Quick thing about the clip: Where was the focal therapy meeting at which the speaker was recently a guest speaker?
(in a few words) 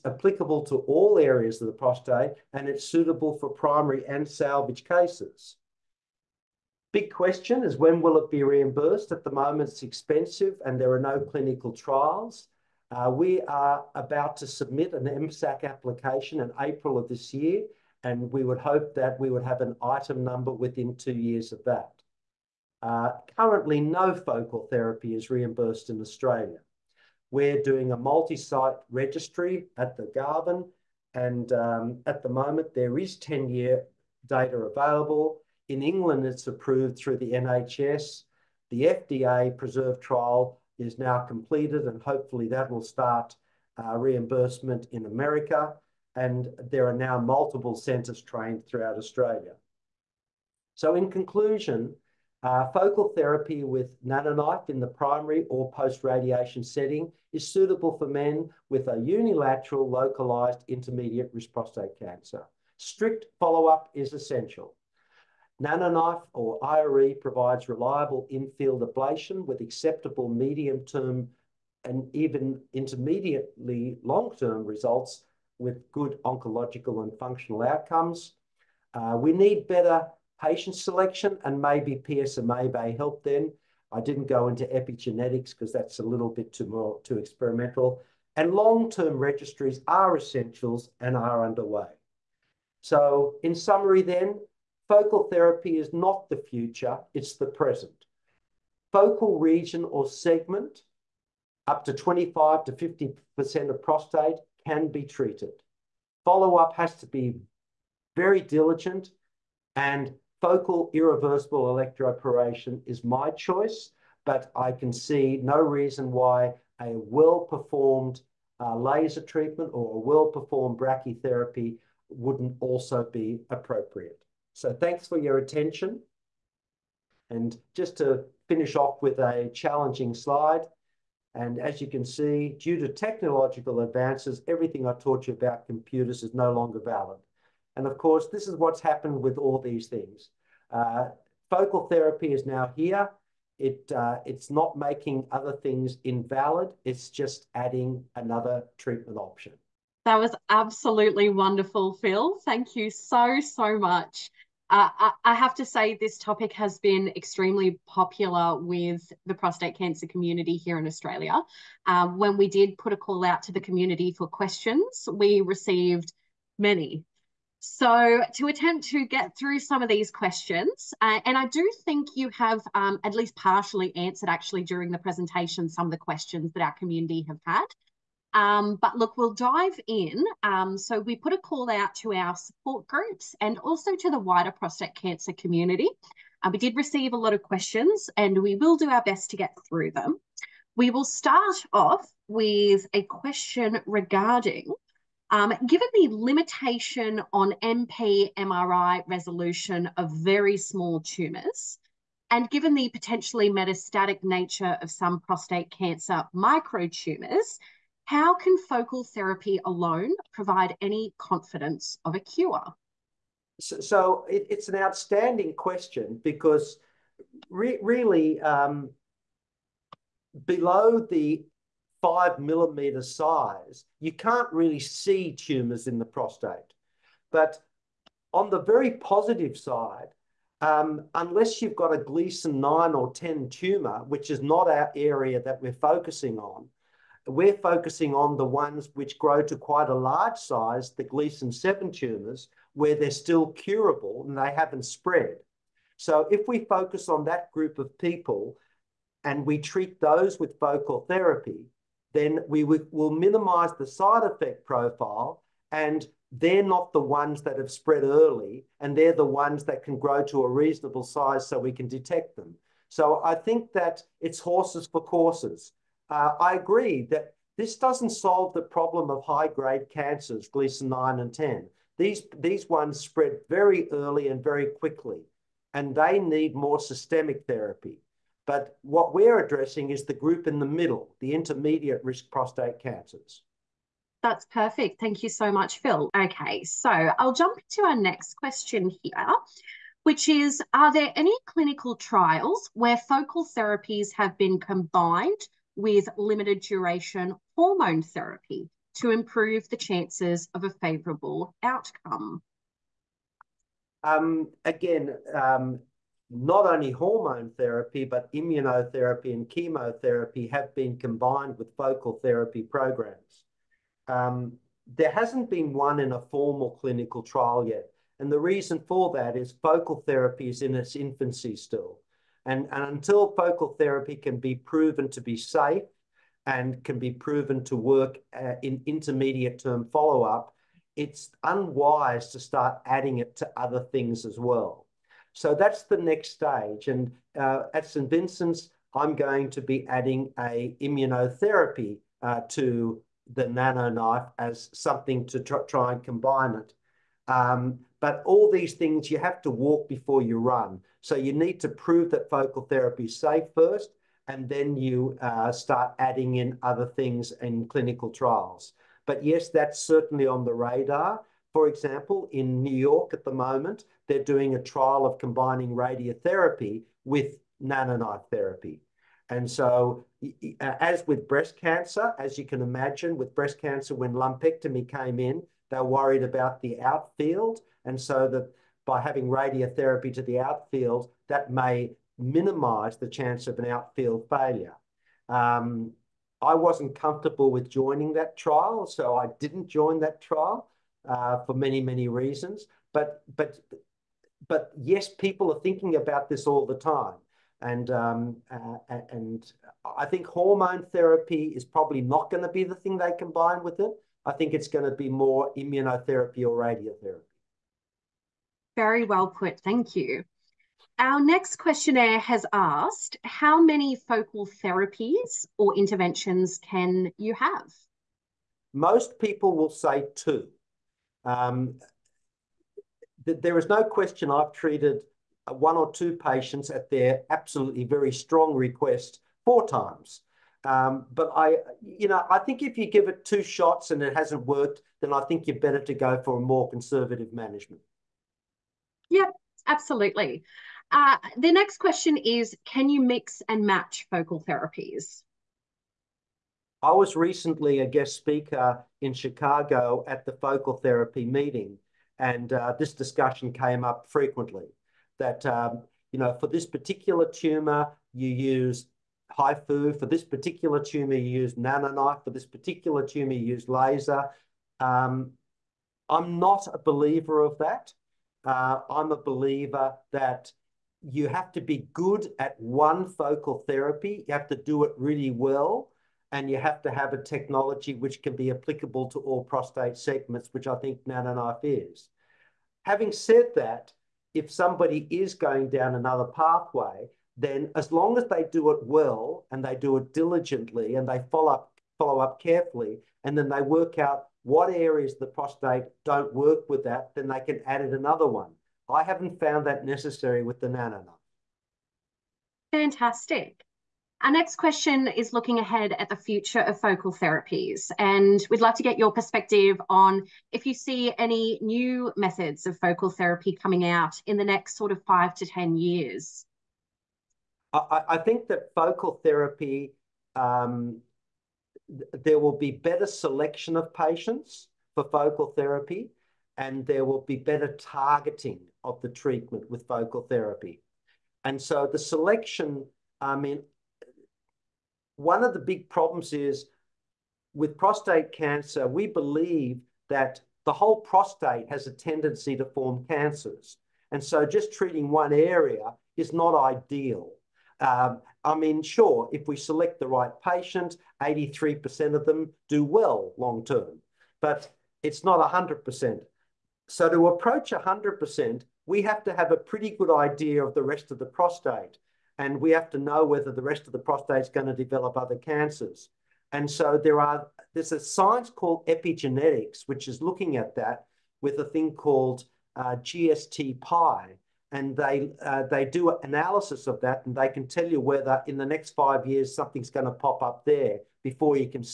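Chicago.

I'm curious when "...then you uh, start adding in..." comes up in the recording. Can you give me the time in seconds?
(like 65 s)
354 s.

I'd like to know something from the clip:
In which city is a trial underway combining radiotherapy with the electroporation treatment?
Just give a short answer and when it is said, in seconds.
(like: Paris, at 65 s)
New York, at 362 s.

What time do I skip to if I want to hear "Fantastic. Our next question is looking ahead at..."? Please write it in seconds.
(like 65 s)
502 s.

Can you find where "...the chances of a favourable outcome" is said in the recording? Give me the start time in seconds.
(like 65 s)
299 s.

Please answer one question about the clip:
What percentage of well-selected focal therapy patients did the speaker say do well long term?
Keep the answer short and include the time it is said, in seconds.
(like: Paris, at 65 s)
83%, at 551 s.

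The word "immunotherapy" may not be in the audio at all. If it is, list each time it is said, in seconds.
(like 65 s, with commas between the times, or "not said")
308 s, 340 s, 405 s.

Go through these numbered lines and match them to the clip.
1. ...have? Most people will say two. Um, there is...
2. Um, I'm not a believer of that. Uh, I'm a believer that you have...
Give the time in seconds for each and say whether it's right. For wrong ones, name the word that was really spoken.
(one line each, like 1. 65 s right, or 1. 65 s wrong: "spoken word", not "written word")
1. 417 s right
2. 464 s right.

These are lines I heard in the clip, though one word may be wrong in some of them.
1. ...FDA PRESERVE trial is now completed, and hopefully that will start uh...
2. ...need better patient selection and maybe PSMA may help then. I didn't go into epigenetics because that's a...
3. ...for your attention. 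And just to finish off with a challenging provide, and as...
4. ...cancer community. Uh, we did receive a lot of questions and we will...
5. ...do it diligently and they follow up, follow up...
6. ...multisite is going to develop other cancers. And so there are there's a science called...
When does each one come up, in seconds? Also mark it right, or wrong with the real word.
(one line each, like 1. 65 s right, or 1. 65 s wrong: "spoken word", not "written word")
1. 38 s right
2. 79 s right
3. 125 s wrong: "slide", not "provide"
4. 184 s right
5. 489 s right
6. 563 s wrong: "prostate", not "multisite".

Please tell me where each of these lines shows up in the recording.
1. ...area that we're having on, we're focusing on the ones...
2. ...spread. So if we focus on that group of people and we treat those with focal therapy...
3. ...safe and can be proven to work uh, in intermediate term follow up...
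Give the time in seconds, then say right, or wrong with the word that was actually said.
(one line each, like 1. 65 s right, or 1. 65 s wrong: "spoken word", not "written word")
1. 234 s wrong: "focusing", not "having"
2. 244 s right
3. 325 s right.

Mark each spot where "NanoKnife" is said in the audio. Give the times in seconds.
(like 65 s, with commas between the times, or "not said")
54 s, 65 s, 343 s, 367 s, 461 s, 481 s.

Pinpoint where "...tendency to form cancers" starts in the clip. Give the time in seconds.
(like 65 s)
542 s.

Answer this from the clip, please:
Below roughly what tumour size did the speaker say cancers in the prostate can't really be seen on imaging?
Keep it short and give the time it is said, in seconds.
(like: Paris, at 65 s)
5 millimeters, at 221 s.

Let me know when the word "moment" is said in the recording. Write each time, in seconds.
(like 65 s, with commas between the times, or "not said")
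9 s, 32 s, 363 s.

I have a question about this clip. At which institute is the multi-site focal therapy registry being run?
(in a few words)
Garvan.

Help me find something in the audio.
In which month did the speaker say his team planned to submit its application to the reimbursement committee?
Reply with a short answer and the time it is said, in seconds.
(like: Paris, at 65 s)
April, at 16 s.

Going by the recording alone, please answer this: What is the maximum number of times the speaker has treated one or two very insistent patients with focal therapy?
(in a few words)
4.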